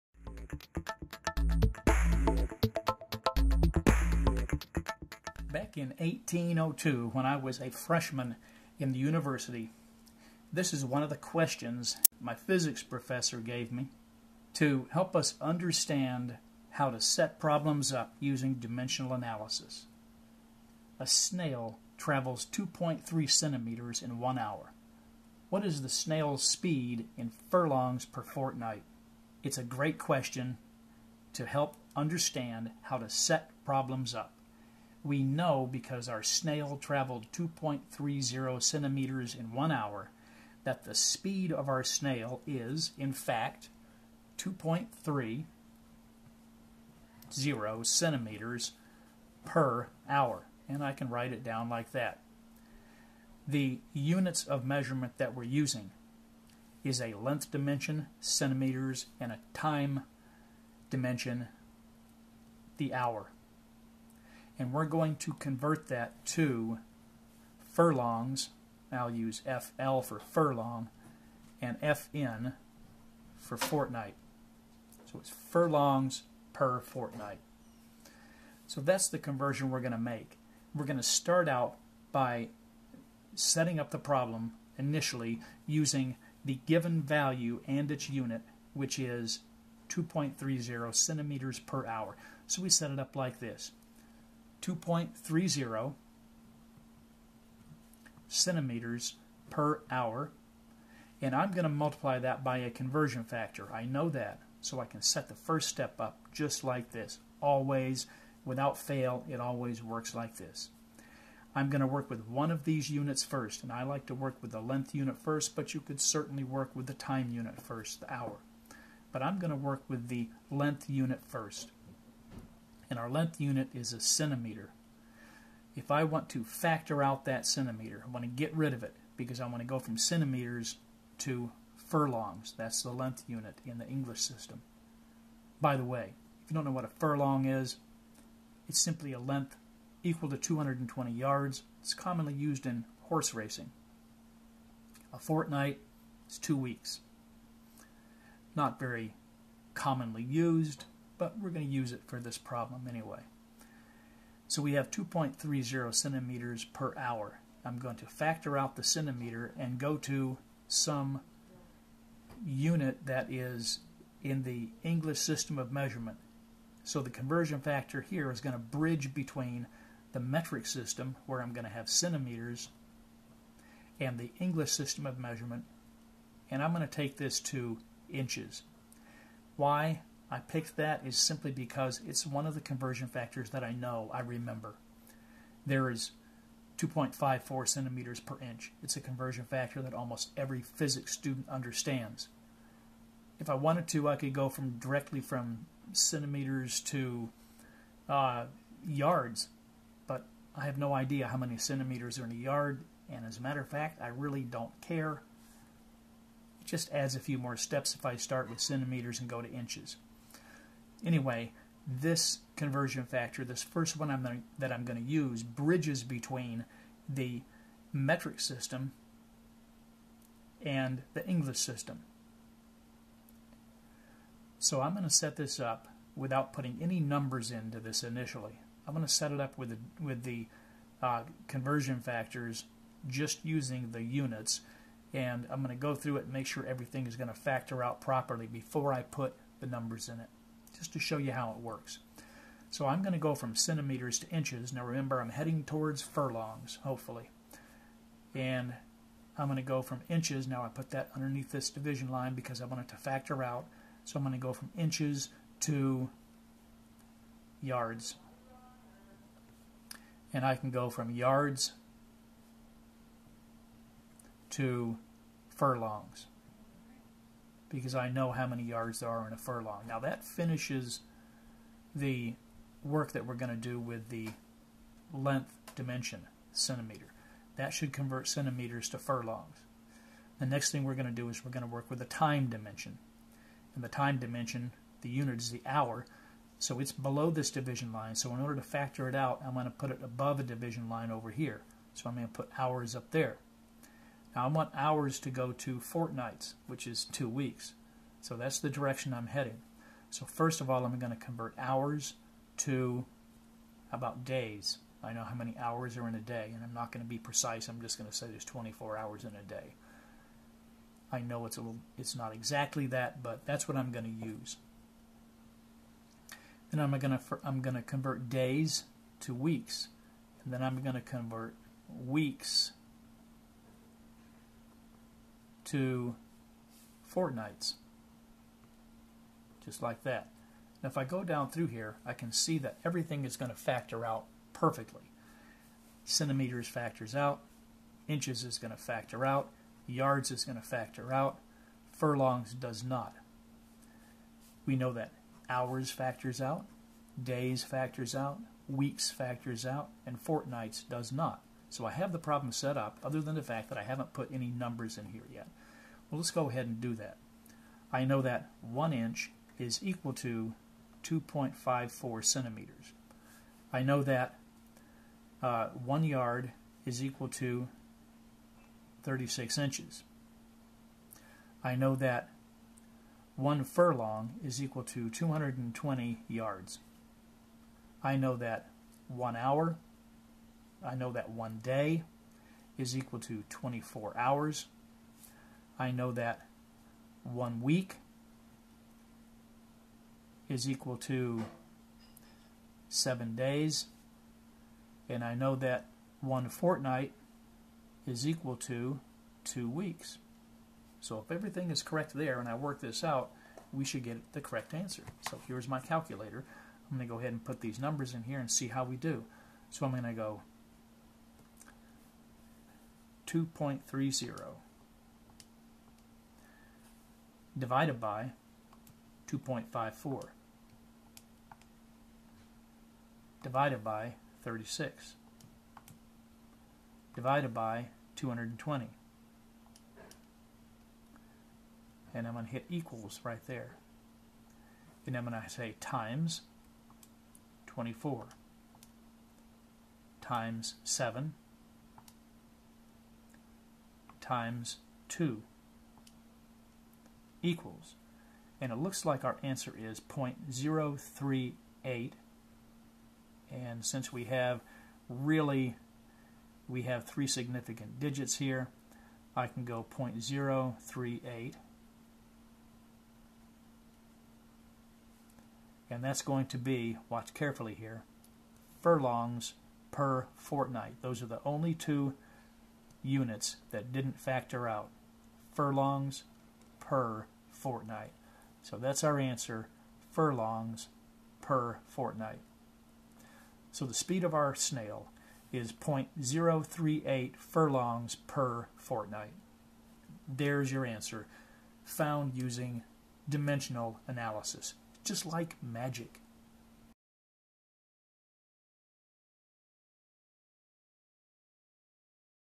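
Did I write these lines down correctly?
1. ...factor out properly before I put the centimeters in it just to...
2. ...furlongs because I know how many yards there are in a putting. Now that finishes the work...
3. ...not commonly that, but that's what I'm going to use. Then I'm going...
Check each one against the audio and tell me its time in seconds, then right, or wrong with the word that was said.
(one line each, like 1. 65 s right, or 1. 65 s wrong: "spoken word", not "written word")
1. 237 s wrong: "numbers", not "centimeters"
2. 265 s wrong: "furlong", not "putting"
3. 312 s wrong: "exactly", not "commonly".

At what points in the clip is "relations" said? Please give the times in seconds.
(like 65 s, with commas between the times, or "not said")
not said.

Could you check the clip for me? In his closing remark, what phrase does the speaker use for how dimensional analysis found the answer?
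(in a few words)
just like magic.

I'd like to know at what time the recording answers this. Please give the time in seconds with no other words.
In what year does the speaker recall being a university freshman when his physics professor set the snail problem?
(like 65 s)
5 s.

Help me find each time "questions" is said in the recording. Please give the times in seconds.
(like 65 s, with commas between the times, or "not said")
11 s, 29 s.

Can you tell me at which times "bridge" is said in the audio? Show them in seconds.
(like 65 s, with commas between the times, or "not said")
168 s, 215 s.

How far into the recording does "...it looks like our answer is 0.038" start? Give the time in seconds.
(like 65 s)
448 s.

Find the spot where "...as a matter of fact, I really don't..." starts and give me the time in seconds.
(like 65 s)
203 s.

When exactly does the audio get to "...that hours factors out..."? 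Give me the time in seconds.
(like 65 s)
344 s.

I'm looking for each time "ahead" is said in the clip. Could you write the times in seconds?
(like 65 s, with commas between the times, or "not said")
356 s, 407 s.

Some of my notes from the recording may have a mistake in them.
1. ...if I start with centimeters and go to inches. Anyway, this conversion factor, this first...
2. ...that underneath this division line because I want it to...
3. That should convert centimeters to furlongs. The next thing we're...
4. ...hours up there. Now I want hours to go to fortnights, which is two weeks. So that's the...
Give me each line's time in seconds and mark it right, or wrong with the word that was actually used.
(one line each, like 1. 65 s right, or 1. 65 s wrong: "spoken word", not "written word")
1. 207 s right
2. 250 s right
3. 277 s right
4. 292 s right.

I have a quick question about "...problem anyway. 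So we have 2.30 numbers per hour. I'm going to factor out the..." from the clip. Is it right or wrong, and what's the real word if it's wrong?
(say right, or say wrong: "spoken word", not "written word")
wrong: "centimeters", not "numbers".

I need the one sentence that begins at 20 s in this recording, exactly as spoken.
A snail travels 2.3 centimeters in one hour.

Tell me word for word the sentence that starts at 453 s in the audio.
And since we have really, we have three significant digits here, I can go 0.038.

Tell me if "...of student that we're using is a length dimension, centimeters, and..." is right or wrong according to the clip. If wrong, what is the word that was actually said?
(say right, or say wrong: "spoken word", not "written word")
wrong: "measurement", not "student".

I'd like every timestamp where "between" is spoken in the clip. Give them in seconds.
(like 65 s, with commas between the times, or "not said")
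169 s, 216 s.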